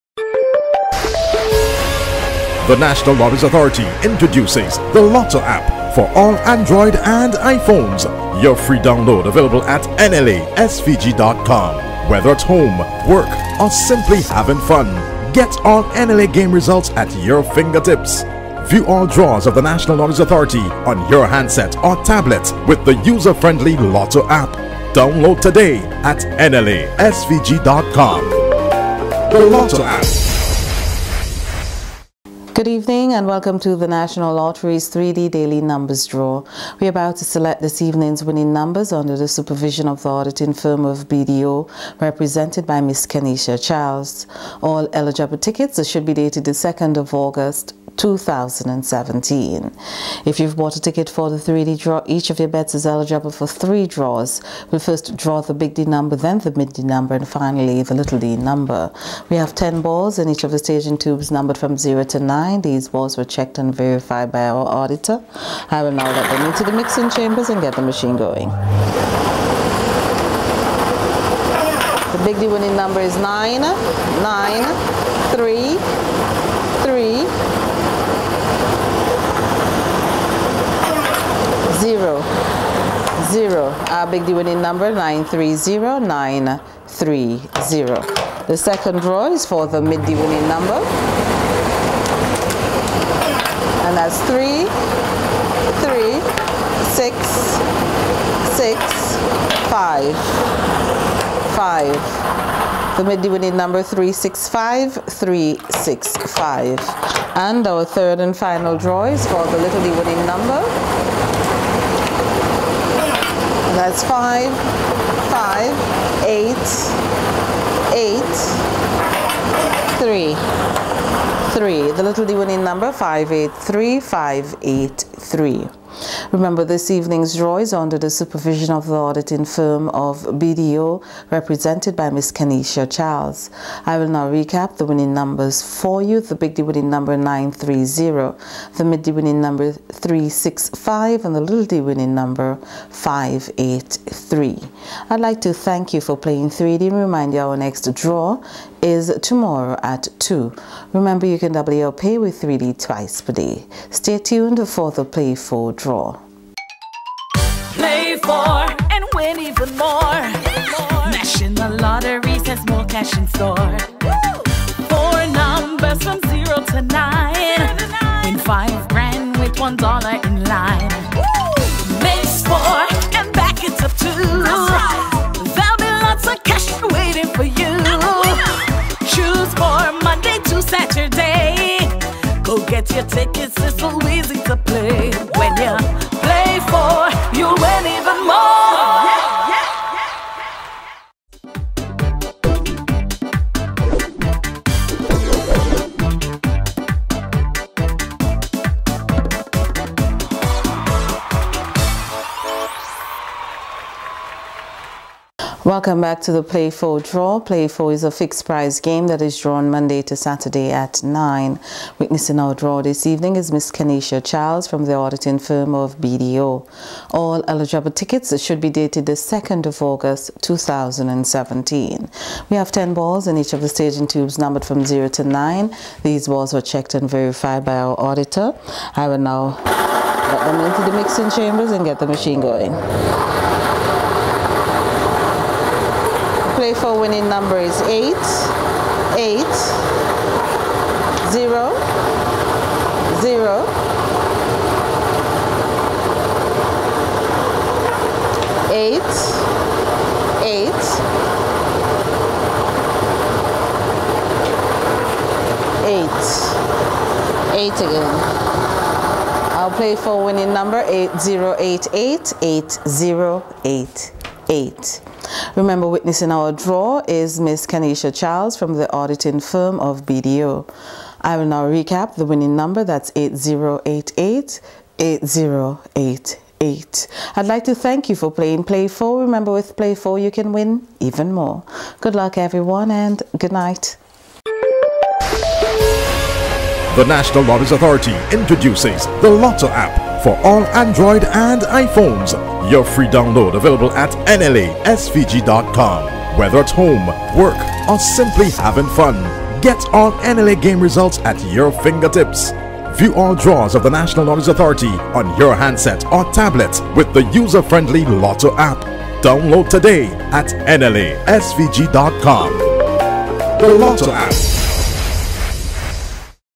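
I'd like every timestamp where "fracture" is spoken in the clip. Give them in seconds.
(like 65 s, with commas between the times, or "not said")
not said.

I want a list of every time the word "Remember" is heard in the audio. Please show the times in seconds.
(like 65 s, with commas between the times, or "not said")
126 s, 150 s, 265 s, 279 s.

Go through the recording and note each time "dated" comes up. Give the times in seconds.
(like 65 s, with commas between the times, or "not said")
46 s, 218 s.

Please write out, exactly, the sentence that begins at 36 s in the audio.
We're about to select this evening's winning numbers under the supervision of the auditing firm of BDO, represented by Miss Kenesha Charles.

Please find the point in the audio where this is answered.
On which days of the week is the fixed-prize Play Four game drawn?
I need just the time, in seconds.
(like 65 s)
209 s.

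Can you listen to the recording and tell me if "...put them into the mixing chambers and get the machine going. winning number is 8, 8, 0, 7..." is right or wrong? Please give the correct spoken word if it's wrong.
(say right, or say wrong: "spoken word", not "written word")
wrong: "0", not "7".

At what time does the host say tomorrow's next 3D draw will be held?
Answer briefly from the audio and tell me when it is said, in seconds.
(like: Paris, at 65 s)
2, at 149 s.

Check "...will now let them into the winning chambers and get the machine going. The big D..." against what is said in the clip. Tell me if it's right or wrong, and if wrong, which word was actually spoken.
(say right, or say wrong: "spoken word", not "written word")
wrong: "mixing", not "winning".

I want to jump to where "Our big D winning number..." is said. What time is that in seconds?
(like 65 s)
83 s.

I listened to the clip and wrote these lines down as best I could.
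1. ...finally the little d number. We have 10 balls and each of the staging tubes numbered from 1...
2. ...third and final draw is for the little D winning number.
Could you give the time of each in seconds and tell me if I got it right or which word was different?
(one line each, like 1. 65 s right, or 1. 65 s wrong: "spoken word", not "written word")
1. 57 s wrong: "0", not "1"
2. 107 s right.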